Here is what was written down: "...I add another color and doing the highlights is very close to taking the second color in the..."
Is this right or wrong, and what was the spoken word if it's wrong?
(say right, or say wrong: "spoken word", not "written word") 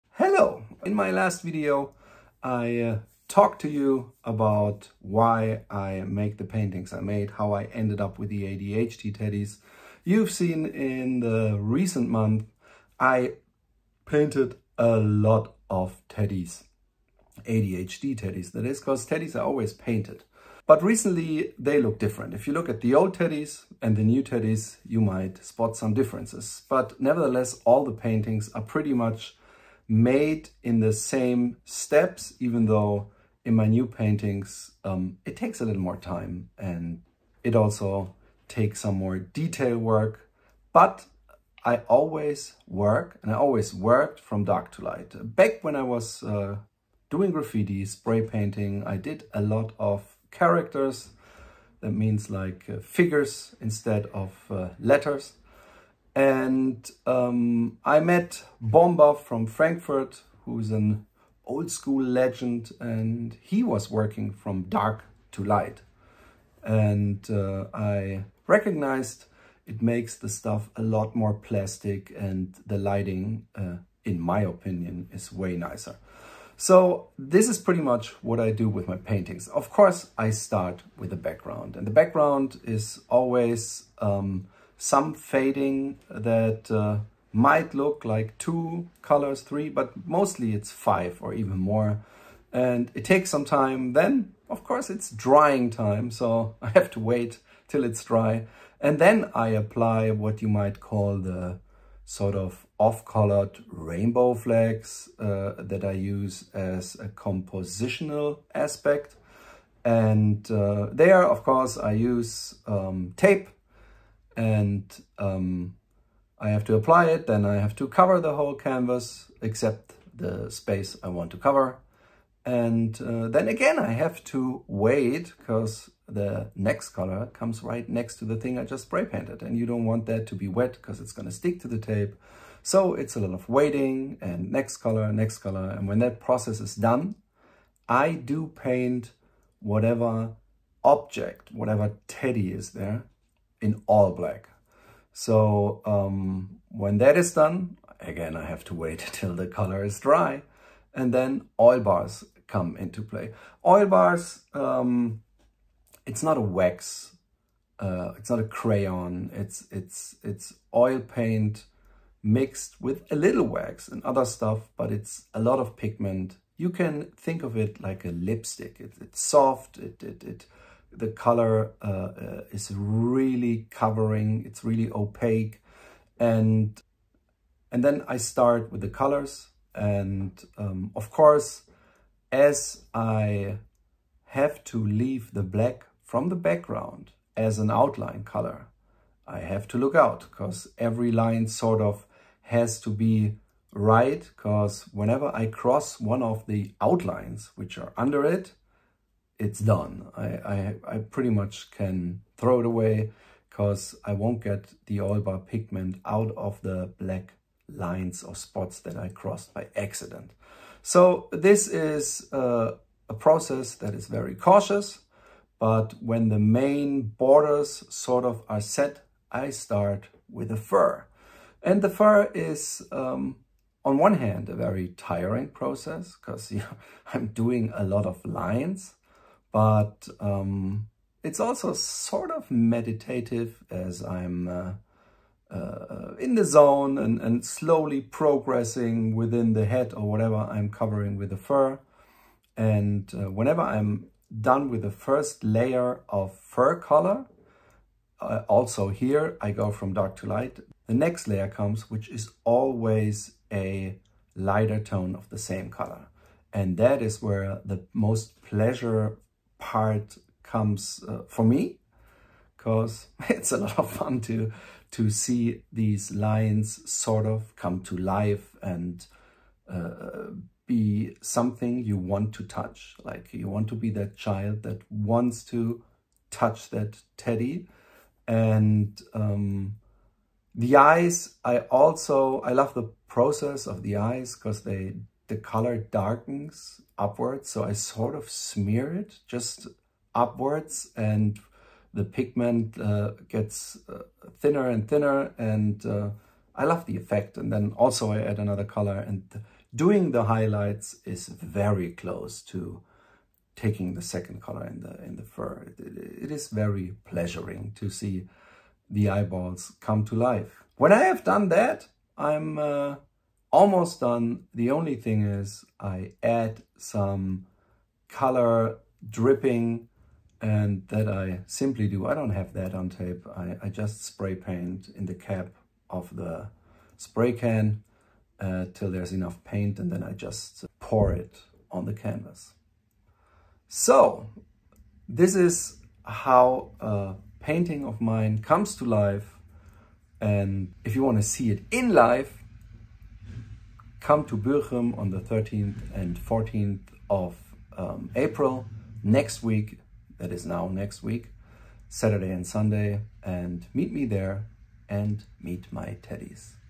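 right.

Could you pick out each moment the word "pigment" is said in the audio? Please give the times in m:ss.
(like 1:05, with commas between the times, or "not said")
2:45, 3:25, 4:52.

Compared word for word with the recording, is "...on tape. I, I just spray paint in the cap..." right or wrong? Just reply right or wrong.
right.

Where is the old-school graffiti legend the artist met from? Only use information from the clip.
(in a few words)
Frankfurt.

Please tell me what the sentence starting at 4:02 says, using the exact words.
And uh, whenever I'm done with the first layer of fur color, uh, also here I go from dark to light.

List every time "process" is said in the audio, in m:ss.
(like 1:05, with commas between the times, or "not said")
2:16, 3:33, 3:45, 4:43.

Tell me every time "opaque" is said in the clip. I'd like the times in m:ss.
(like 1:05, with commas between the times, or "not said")
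2:54.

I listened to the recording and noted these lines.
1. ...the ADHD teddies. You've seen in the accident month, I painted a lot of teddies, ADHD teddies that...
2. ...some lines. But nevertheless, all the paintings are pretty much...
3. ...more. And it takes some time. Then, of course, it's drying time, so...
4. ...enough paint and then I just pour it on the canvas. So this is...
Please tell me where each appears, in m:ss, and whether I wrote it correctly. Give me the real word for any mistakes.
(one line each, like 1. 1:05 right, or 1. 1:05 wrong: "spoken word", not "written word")
1. 0:08 wrong: "recent", not "accident"
2. 0:25 wrong: "differences", not "lines"
3. 1:31 right
4. 5:29 right.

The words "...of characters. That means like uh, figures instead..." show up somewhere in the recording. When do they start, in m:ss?
0:49.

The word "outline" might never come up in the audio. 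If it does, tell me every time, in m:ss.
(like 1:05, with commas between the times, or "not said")
3:07, 3:16.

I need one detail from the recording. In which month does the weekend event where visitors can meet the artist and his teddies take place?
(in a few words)
April.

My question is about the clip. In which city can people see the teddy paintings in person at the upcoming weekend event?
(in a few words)
Bochum.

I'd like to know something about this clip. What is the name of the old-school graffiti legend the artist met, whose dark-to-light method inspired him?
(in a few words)
Bomber.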